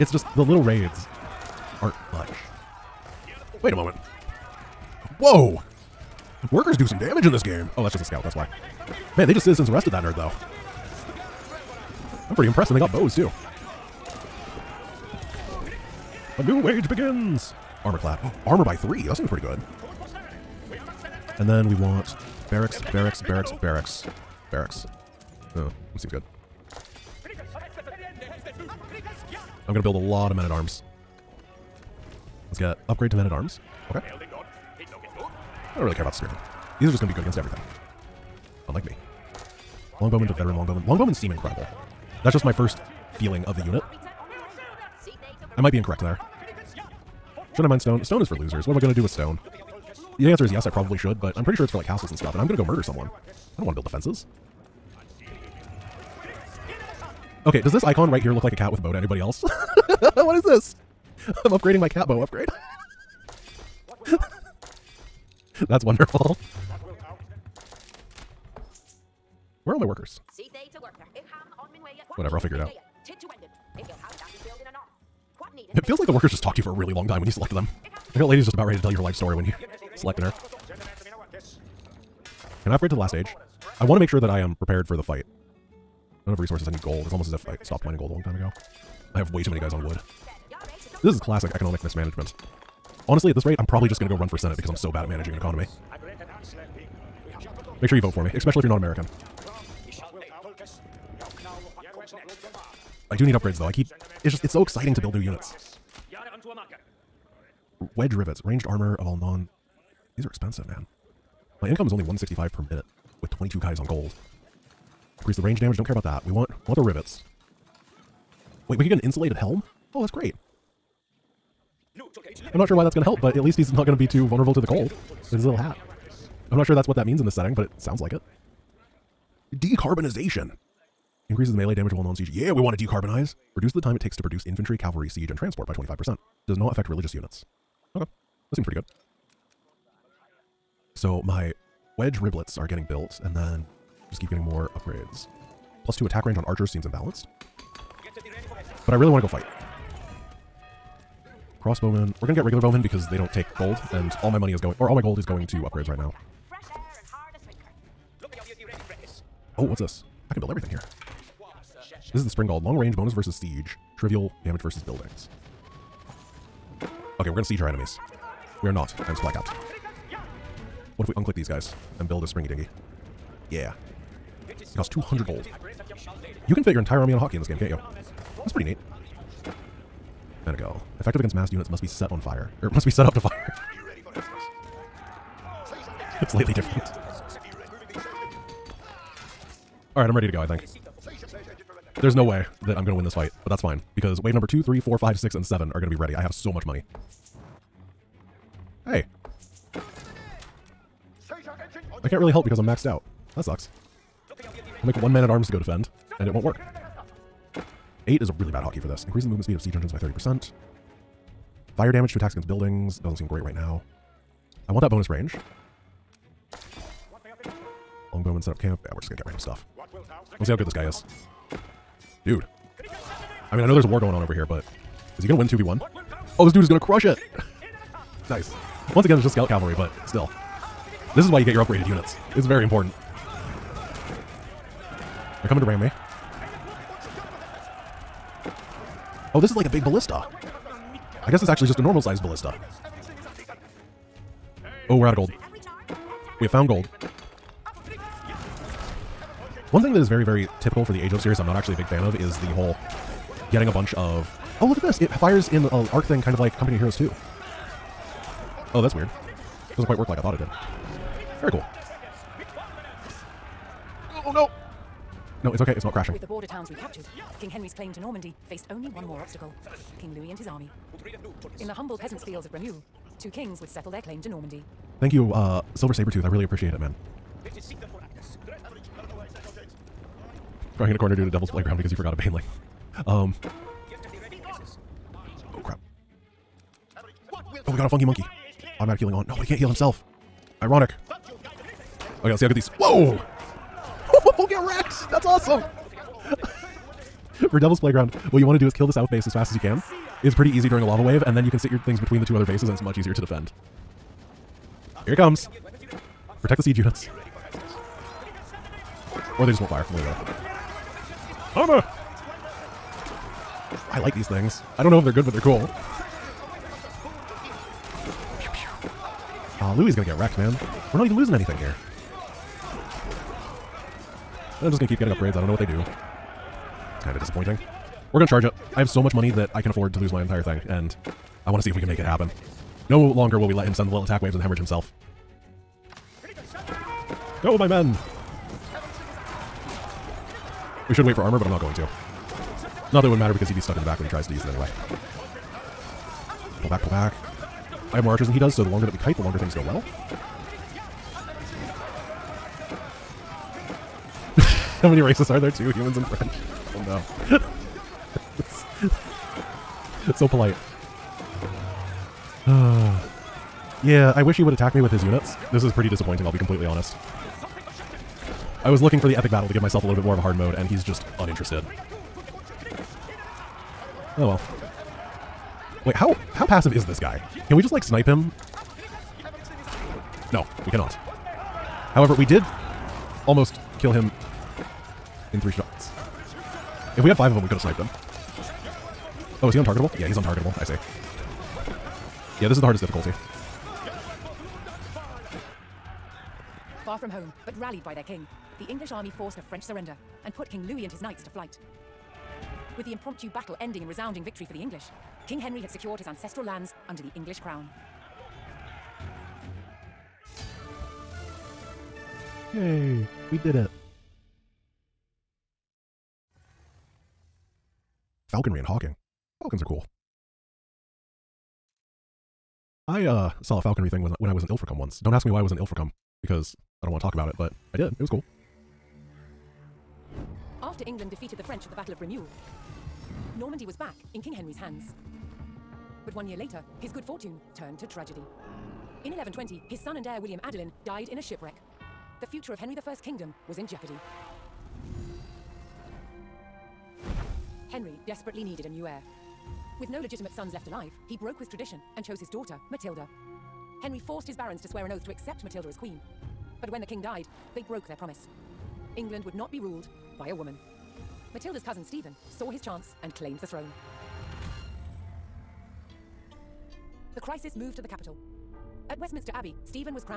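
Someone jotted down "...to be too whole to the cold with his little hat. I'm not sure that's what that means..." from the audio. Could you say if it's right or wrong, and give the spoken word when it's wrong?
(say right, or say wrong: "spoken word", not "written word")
wrong: "vulnerable", not "whole".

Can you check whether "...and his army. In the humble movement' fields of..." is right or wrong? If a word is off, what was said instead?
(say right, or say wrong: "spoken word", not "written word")
wrong: "peasants", not "movement".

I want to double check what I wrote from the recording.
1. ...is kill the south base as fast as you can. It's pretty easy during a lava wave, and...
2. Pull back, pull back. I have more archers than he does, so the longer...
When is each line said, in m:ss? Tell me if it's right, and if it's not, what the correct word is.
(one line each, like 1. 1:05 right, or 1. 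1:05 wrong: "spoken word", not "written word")
1. 4:58 right
2. 5:46 right.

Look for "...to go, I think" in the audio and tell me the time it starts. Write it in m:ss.
3:10.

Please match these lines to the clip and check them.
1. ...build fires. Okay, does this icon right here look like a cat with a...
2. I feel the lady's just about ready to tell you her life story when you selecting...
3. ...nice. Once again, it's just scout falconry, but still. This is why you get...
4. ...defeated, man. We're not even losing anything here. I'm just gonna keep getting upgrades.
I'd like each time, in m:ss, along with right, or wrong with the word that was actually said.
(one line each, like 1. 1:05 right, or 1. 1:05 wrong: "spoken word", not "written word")
1. 0:53 wrong: "defenses", not "fires"
2. 1:17 right
3. 3:48 wrong: "cavalry", not "falconry"
4. 5:20 wrong: "wrecked", not "defeated".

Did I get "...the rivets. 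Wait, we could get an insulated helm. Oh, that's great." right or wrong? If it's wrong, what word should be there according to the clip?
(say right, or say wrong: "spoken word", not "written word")
right.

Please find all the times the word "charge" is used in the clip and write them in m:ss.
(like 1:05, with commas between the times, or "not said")
5:28.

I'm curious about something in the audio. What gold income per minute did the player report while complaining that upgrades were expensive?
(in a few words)
165.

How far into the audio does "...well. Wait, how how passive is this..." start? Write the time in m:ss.
6:14.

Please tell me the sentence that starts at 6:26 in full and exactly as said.
If we had five of them, we could have sniped him.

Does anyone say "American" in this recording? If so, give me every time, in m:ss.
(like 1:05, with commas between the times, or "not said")
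1:38.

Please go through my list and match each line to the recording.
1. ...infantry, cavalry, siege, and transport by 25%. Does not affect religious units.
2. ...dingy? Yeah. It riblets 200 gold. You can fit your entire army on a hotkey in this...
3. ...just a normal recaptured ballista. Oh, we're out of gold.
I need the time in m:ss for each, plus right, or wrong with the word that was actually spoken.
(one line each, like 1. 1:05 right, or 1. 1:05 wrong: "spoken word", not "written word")
1. 2:14 right
2. 2:52 wrong: "costs", not "riblets"
3. 4:01 wrong: "sized", not "recaptured".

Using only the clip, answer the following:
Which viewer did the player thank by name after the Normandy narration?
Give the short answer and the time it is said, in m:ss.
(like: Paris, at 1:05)
Silver Sabretooth, at 4:35.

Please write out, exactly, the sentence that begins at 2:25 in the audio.
Plus two attack range on archers seems imbalanced.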